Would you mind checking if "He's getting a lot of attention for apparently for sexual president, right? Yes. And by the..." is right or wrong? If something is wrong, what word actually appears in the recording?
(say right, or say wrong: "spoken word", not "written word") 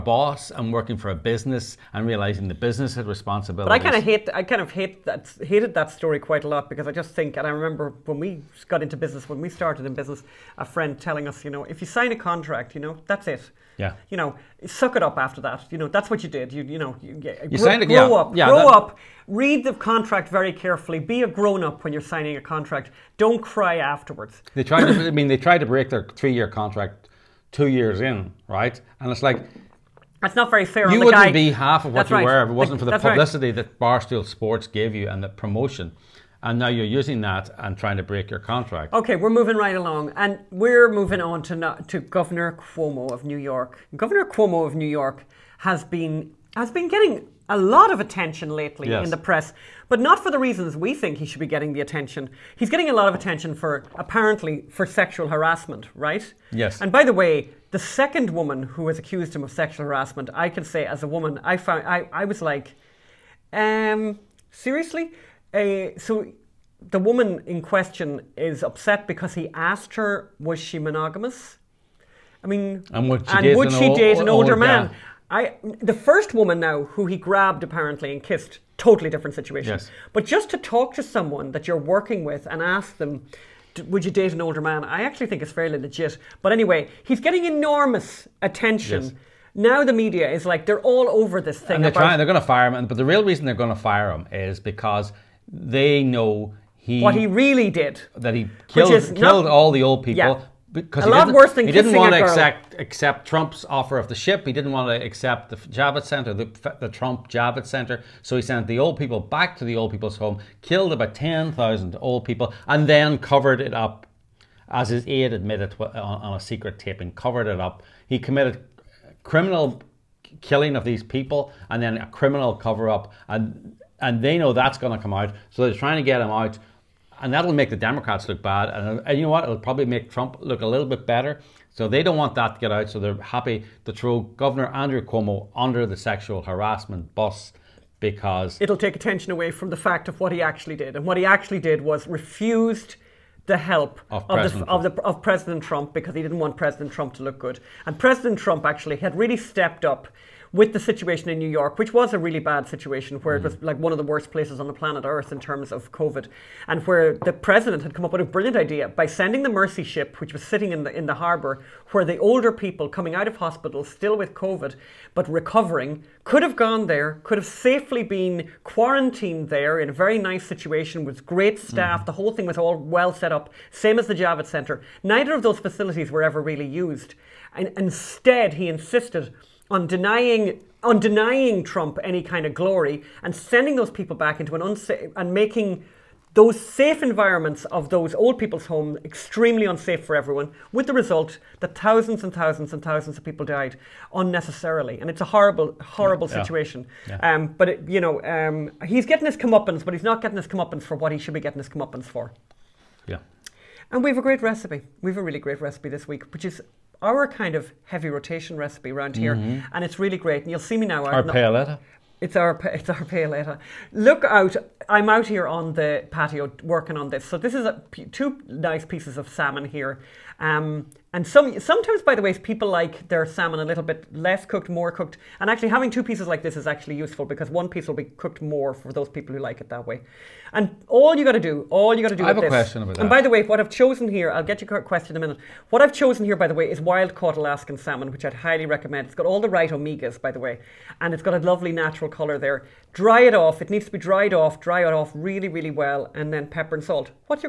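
wrong: "harassment", not "president".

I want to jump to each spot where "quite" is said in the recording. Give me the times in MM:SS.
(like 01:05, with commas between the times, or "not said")
00:06.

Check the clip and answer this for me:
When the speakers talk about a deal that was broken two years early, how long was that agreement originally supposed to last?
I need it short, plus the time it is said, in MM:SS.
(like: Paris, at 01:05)
3 years, at 00:26.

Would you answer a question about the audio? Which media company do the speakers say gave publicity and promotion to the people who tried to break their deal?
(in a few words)
Barstool Sports.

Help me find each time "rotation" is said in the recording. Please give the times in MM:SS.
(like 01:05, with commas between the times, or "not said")
03:28.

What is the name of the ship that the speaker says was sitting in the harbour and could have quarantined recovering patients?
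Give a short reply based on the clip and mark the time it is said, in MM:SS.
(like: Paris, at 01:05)
Mercy, at 02:39.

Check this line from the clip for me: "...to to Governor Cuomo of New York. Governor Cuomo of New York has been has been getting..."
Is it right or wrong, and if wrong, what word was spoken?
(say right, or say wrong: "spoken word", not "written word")
right.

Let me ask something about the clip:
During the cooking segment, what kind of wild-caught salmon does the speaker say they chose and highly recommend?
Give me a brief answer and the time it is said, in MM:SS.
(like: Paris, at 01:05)
Alaskan, at 03:57.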